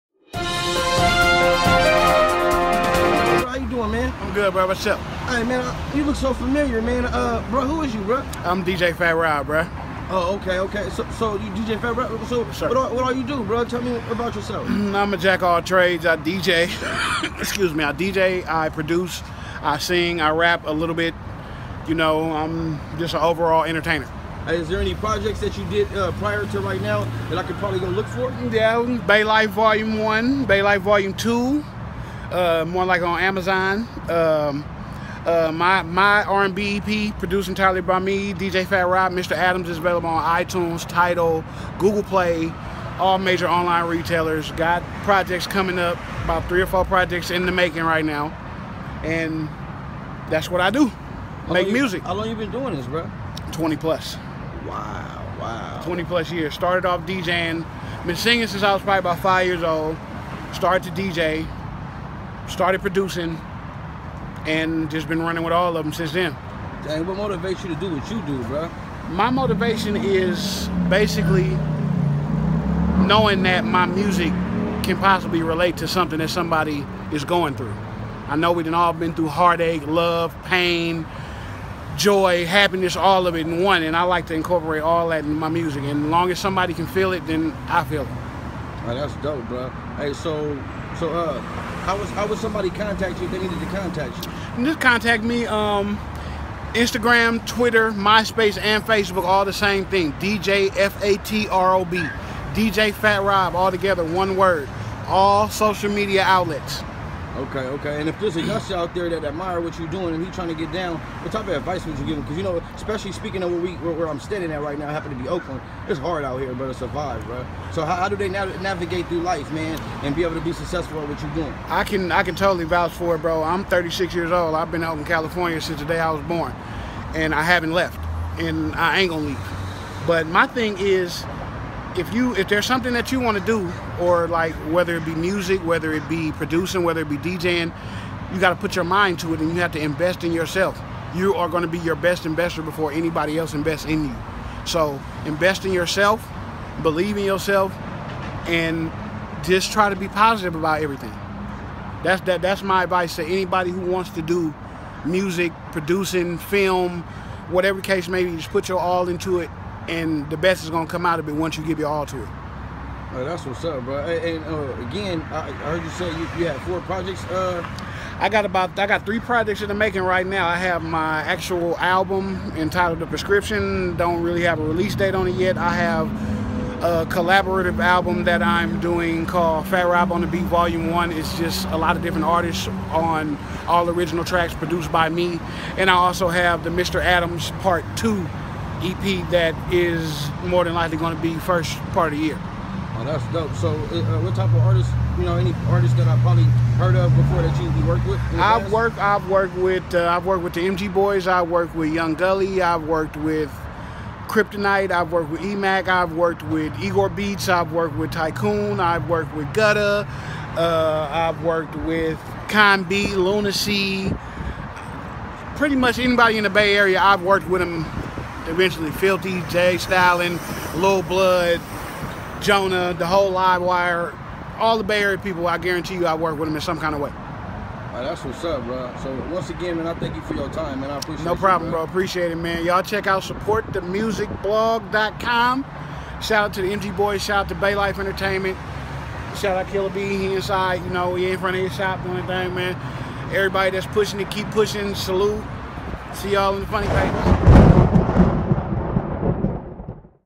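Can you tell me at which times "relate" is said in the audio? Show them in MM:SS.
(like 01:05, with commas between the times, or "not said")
01:15.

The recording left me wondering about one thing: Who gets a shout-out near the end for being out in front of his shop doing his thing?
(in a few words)
Killer B.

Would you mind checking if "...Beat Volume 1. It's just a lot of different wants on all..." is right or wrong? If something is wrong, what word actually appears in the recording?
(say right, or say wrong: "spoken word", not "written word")
wrong: "artists", not "wants".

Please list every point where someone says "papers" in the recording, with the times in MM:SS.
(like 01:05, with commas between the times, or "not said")
04:06.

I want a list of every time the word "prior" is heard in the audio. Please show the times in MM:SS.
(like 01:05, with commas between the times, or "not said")
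00:26.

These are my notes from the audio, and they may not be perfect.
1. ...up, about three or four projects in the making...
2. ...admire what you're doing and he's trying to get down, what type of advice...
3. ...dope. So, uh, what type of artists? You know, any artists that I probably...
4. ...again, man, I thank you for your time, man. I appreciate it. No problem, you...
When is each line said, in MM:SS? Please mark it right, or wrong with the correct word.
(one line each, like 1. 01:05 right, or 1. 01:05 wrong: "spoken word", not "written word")
1. 00:45 right
2. 01:49 right
3. 03:13 right
4. 03:49 right.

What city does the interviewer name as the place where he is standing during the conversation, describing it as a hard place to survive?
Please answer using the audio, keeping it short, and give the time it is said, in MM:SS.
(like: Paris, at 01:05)
Oakland, at 01:55.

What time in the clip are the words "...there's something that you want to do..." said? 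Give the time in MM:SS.
02:12.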